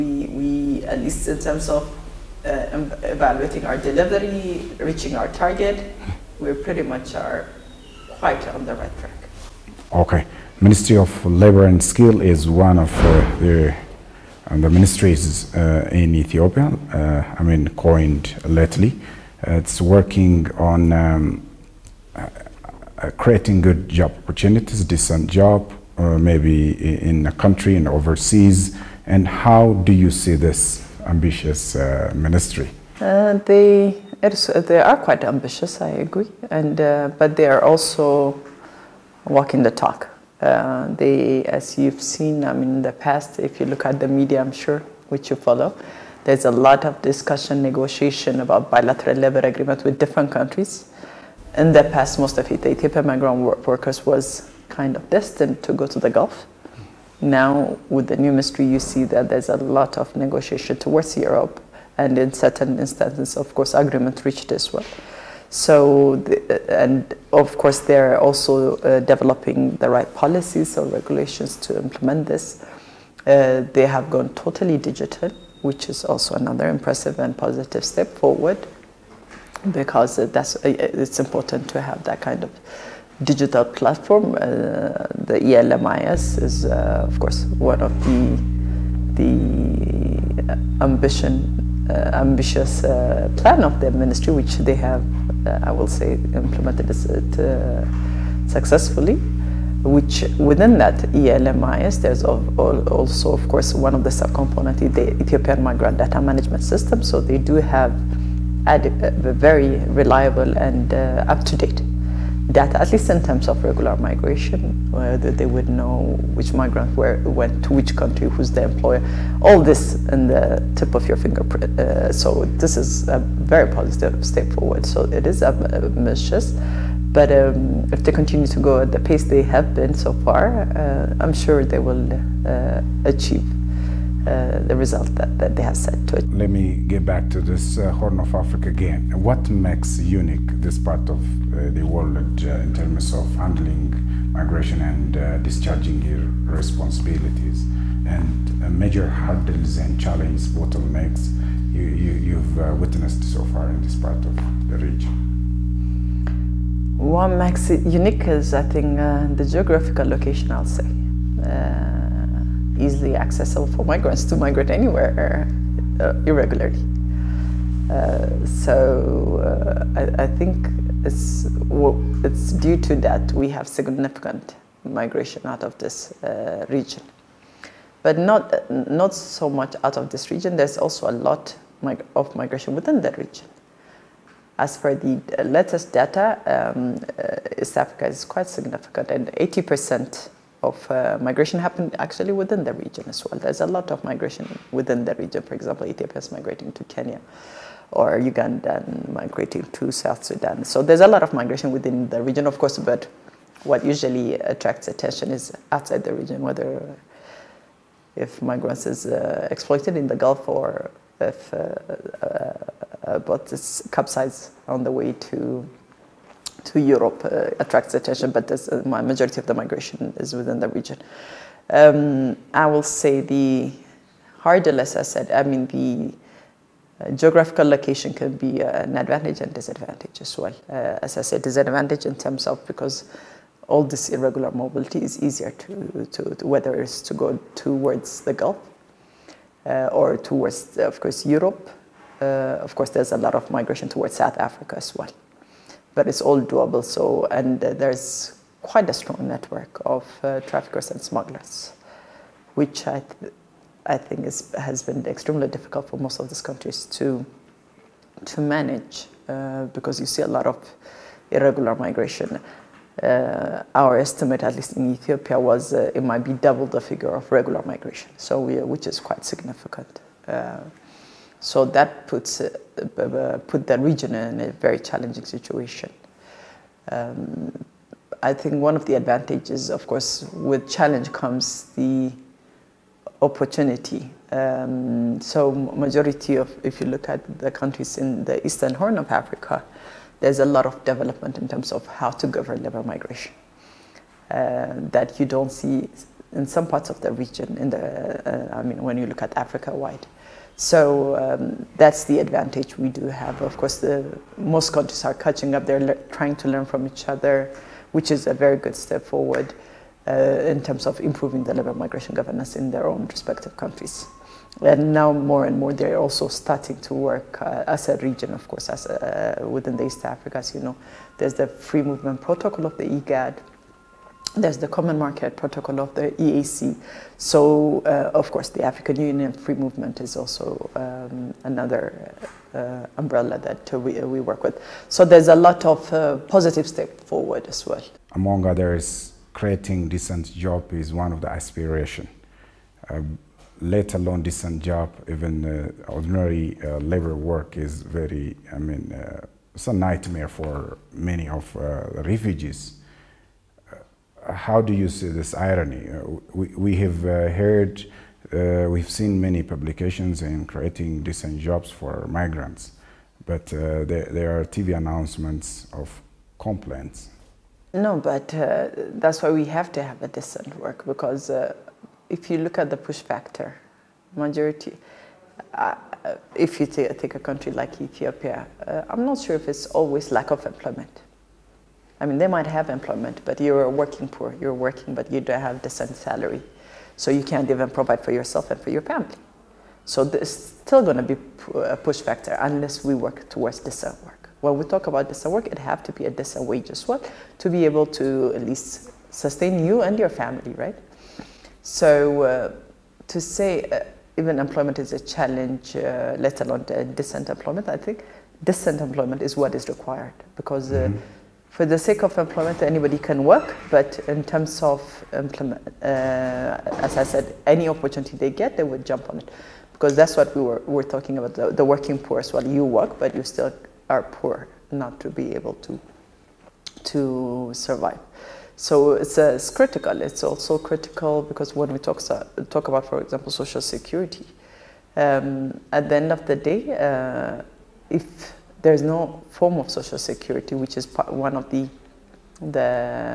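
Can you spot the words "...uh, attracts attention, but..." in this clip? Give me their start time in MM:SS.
03:37.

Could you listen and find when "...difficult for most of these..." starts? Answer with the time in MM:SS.
04:15.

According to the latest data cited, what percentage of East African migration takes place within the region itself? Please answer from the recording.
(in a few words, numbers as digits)
80%.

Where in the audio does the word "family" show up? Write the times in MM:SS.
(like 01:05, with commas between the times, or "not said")
06:28, 06:40.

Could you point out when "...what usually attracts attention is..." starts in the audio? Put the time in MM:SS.
03:23.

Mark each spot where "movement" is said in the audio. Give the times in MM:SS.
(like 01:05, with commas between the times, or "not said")
05:21, 05:29.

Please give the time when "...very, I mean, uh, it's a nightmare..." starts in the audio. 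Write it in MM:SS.
05:47.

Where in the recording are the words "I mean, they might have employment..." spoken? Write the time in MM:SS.
06:22.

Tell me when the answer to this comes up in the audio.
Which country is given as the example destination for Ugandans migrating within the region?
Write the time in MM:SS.
03:19.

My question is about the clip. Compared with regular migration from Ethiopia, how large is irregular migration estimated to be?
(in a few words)
double.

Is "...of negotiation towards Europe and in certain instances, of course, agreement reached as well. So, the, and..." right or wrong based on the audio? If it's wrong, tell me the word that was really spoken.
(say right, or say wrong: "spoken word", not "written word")
right.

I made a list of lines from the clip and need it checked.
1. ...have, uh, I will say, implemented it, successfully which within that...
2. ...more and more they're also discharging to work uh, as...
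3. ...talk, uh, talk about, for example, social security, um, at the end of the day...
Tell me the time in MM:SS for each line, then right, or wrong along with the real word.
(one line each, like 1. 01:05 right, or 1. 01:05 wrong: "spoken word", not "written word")
1. 01:34 right
2. 05:15 wrong: "starting", not "discharging"
3. 07:11 right.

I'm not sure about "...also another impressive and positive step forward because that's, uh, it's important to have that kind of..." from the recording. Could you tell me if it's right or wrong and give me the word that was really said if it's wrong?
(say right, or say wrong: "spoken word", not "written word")
right.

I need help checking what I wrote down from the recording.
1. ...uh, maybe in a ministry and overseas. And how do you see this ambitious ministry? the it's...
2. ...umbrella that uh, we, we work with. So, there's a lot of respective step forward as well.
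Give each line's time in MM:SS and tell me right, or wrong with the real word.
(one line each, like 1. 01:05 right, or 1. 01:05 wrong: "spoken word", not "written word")
1. 00:25 wrong: "country", not "ministry"
2. 05:32 wrong: "positive", not "respective".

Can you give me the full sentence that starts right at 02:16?
Let me get back to this uh, Horn of Africa again.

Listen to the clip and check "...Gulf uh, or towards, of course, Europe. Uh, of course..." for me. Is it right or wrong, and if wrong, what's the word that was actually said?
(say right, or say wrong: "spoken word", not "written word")
right.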